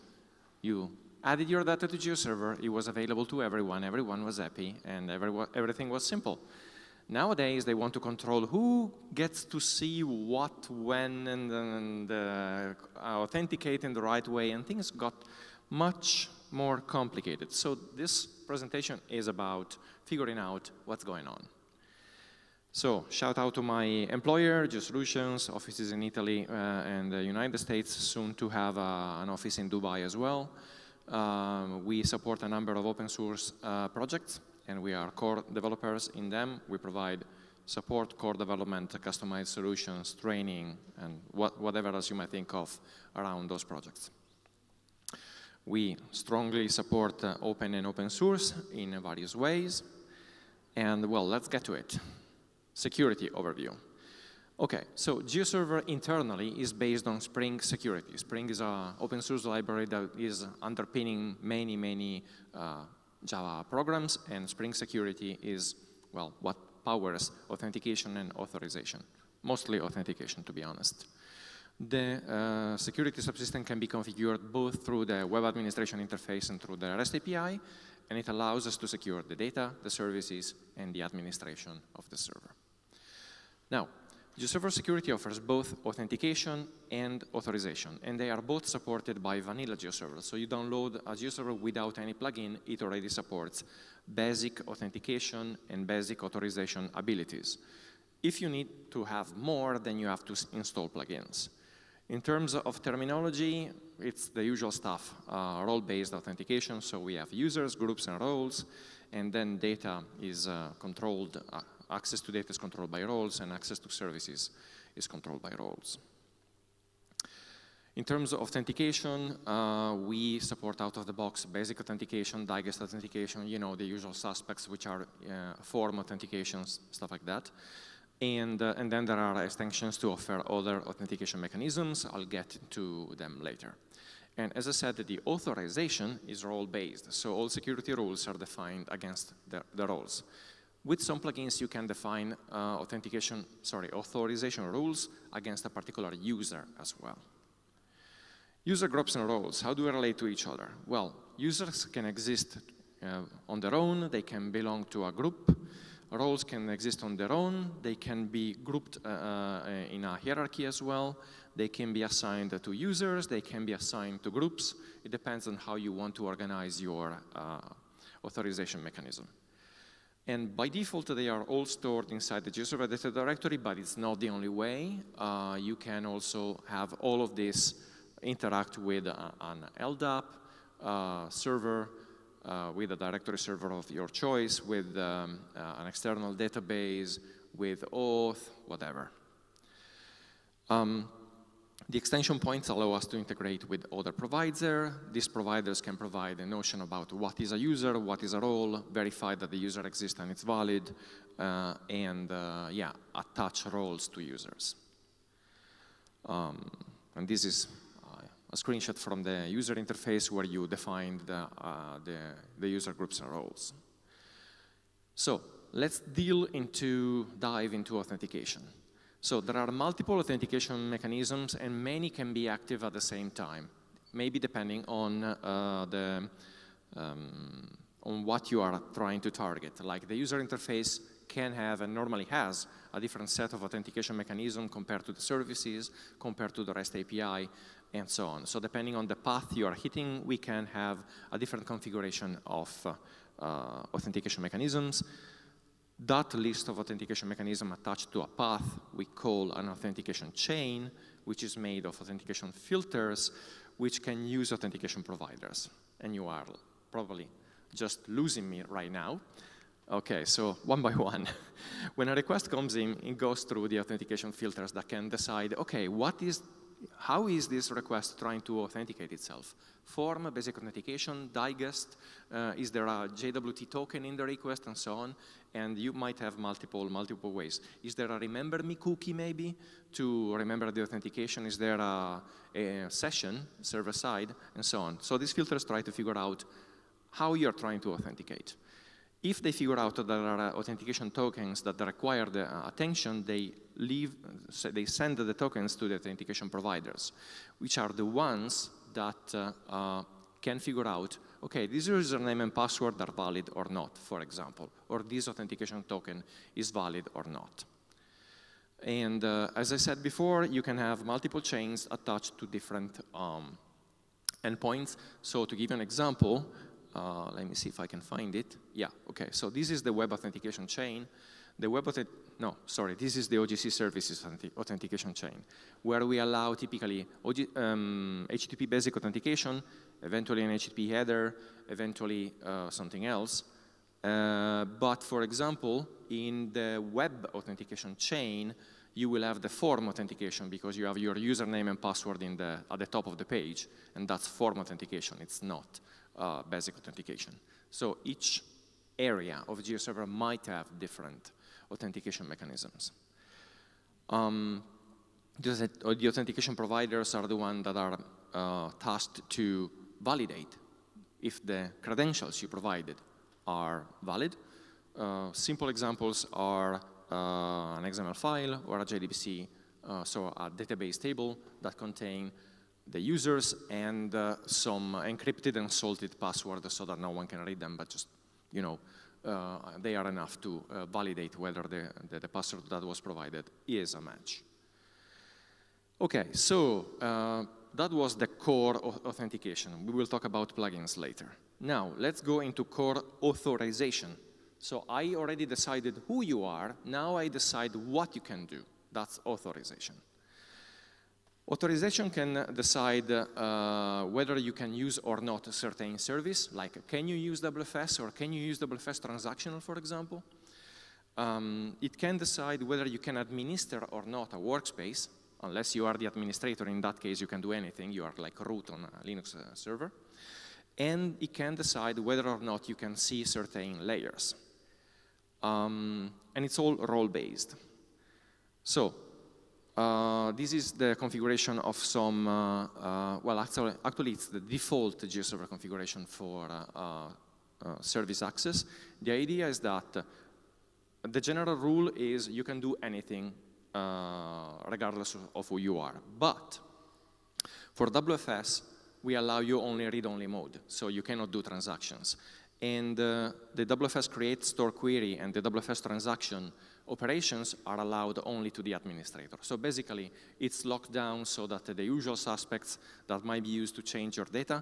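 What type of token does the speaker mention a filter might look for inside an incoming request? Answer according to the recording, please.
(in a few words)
JWT token.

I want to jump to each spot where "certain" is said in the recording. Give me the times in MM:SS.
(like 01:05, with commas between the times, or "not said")
06:45, 07:03.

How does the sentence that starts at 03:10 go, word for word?
Um, the extension points allow us to integrate with other providers.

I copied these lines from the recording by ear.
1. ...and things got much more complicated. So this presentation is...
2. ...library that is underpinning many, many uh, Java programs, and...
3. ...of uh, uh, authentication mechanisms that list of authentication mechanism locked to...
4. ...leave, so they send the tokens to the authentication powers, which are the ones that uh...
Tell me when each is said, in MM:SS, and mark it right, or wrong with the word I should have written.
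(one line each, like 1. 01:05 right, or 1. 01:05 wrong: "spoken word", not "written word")
1. 00:14 right
2. 00:59 right
3. 04:02 wrong: "attached", not "locked"
4. 04:53 wrong: "providers", not "powers".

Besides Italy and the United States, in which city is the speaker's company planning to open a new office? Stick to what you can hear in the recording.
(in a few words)
Dubai.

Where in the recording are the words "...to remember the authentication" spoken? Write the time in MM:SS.
04:39.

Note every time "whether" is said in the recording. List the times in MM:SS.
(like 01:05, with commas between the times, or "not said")
06:21, 06:44, 06:52, 07:01.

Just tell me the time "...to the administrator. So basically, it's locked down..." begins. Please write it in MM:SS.
07:38.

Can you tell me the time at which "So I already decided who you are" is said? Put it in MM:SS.
06:34.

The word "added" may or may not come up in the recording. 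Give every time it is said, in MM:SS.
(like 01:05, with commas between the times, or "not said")
00:01.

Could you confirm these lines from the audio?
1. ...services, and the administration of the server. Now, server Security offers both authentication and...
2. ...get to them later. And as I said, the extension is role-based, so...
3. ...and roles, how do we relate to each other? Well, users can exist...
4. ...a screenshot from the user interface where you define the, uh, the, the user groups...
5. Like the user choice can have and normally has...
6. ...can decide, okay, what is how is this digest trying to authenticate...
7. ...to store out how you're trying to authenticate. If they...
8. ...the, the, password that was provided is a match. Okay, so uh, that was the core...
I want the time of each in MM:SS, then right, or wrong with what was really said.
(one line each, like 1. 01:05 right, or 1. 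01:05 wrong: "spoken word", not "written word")
1. 01:20 right
2. 02:12 wrong: "authorization", not "extension"
3. 02:29 right
4. 03:28 right
5. 03:49 wrong: "interface", not "choice"
6. 04:24 wrong: "request", not "digest"
7. 04:45 wrong: "figure", not "store"
8. 06:22 right.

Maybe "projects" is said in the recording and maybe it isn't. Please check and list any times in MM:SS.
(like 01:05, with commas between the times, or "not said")
00:33, 00:43.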